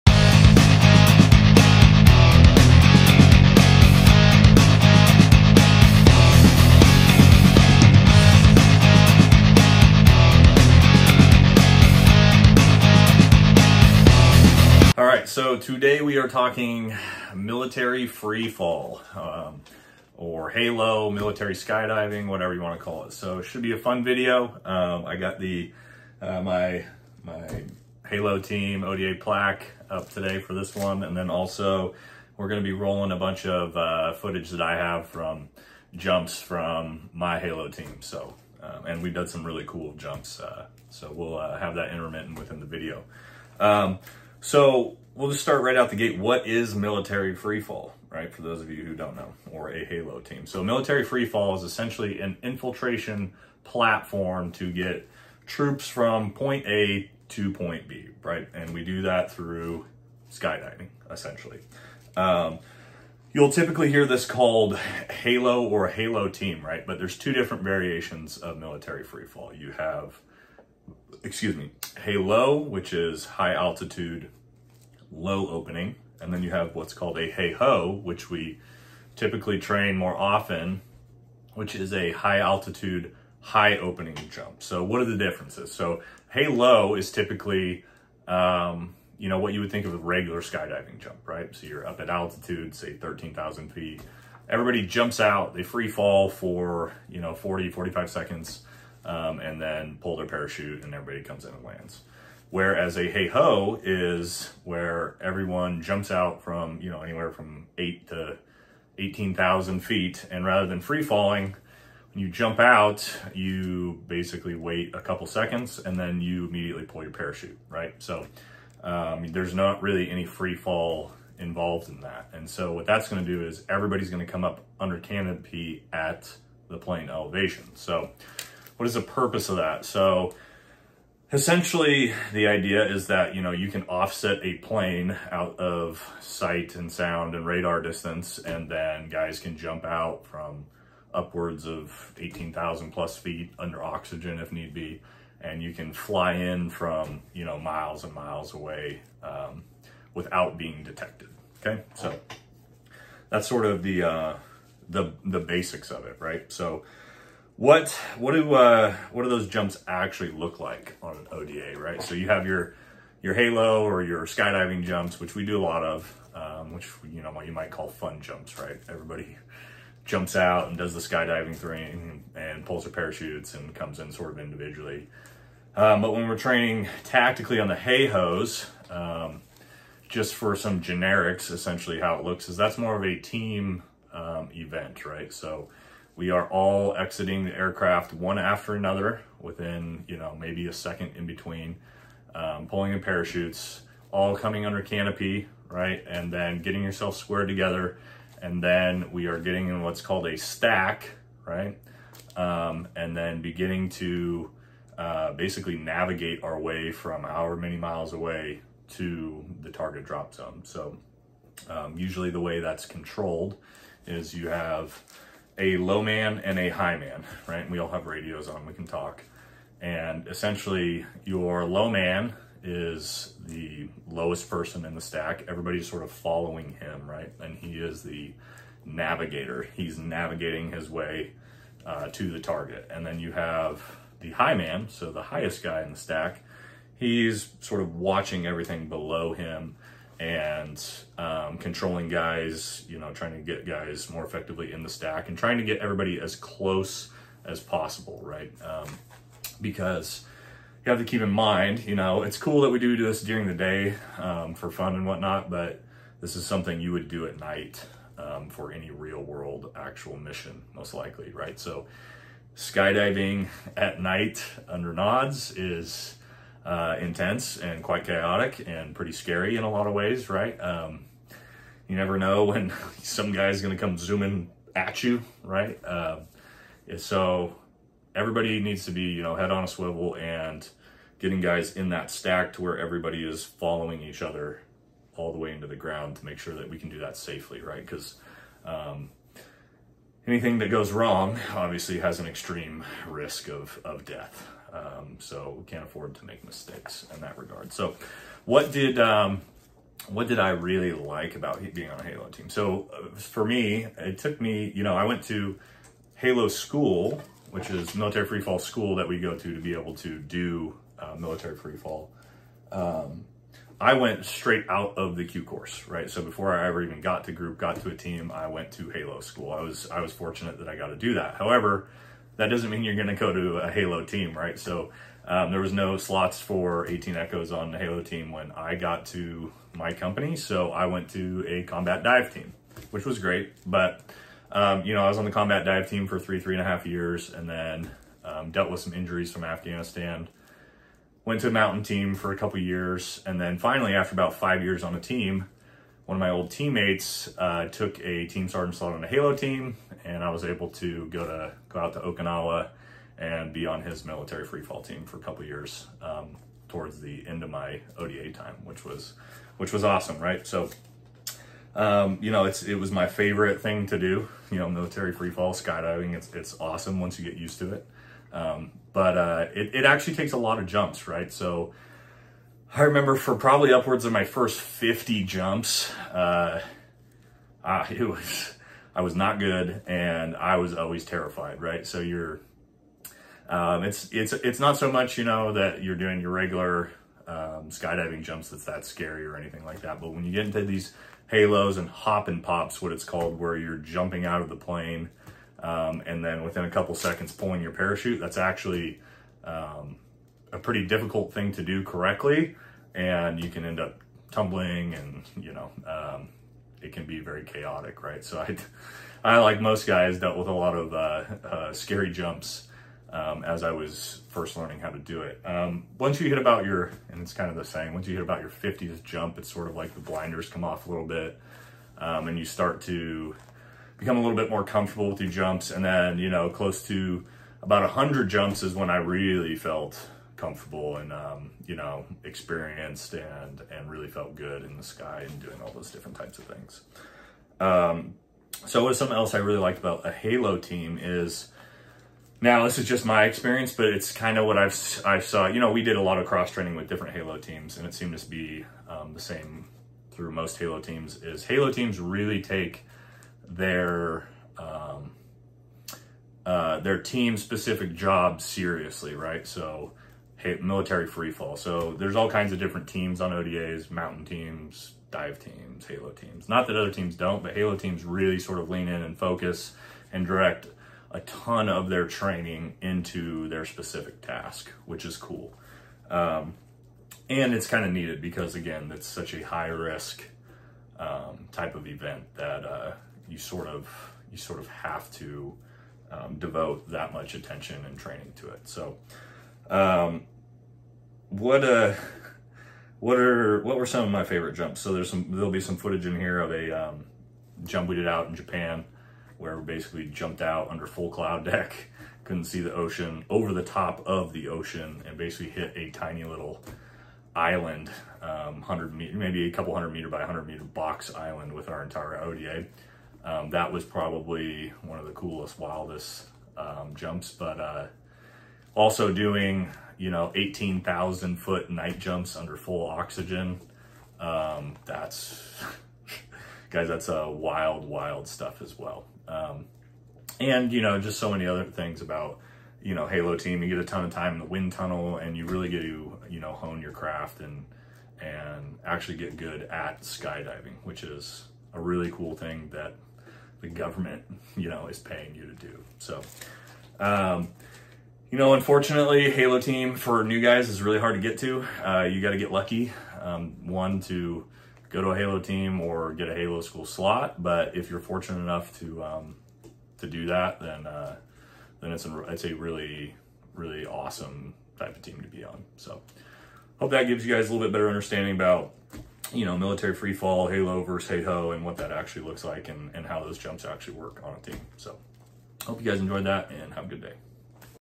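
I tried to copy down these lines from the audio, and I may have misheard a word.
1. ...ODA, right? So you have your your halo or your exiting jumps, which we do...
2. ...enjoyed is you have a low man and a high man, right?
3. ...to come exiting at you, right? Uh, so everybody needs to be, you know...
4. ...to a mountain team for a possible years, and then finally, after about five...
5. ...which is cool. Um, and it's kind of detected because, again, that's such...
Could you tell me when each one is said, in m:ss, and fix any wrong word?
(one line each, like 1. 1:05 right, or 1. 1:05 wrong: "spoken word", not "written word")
1. 2:41 wrong: "skydiving", not "exiting"
2. 3:32 wrong: "controlled", not "enjoyed"
3. 4:33 wrong: "zooming", not "exiting"
4. 5:41 wrong: "couple", not "possible"
5. 7:54 wrong: "needed", not "detected".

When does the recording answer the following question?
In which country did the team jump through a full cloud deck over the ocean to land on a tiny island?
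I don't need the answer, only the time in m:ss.
8:18.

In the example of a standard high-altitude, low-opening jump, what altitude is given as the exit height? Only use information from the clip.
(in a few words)
13,000 feet.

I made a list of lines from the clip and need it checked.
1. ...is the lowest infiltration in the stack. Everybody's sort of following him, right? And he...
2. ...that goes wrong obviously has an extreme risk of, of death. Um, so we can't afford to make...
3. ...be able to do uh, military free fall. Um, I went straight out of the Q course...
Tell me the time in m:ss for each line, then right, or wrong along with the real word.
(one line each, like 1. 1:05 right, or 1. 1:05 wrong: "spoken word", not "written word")
1. 3:42 wrong: "person", not "infiltration"
2. 4:50 right
3. 5:09 right.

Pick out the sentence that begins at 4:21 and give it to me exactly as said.
So skydiving at night under nods is uh, intense and quite chaotic and pretty scary in a lot of ways, right?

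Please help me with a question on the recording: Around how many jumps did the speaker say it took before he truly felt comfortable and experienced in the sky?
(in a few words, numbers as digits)
100.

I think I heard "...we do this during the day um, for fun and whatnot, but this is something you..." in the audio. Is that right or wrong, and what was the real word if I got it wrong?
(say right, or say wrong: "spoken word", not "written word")
right.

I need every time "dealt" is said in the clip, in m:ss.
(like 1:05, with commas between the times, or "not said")
5:38, 6:50.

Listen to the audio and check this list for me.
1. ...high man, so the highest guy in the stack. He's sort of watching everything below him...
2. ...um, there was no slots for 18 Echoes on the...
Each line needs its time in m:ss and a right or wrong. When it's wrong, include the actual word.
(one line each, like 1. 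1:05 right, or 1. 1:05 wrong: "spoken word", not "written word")
1. 3:54 right
2. 5:25 right.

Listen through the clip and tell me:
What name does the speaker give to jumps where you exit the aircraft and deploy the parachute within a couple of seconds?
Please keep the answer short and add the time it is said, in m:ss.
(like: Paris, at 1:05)
hop and pops, at 6:31.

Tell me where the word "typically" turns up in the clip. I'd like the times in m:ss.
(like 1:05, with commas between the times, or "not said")
1:03, 1:19, 1:27.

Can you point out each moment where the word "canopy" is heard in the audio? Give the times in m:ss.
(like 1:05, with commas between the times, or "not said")
2:04, 3:14.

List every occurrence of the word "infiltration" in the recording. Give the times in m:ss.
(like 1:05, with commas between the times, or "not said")
0:52.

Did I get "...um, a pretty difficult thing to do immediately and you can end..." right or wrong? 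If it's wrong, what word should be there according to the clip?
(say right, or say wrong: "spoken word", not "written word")
wrong: "correctly", not "immediately".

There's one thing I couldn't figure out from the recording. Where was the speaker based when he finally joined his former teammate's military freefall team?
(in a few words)
Okinawa.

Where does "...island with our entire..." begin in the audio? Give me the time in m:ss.
8:31.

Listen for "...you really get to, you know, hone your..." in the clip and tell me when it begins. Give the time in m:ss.
8:55.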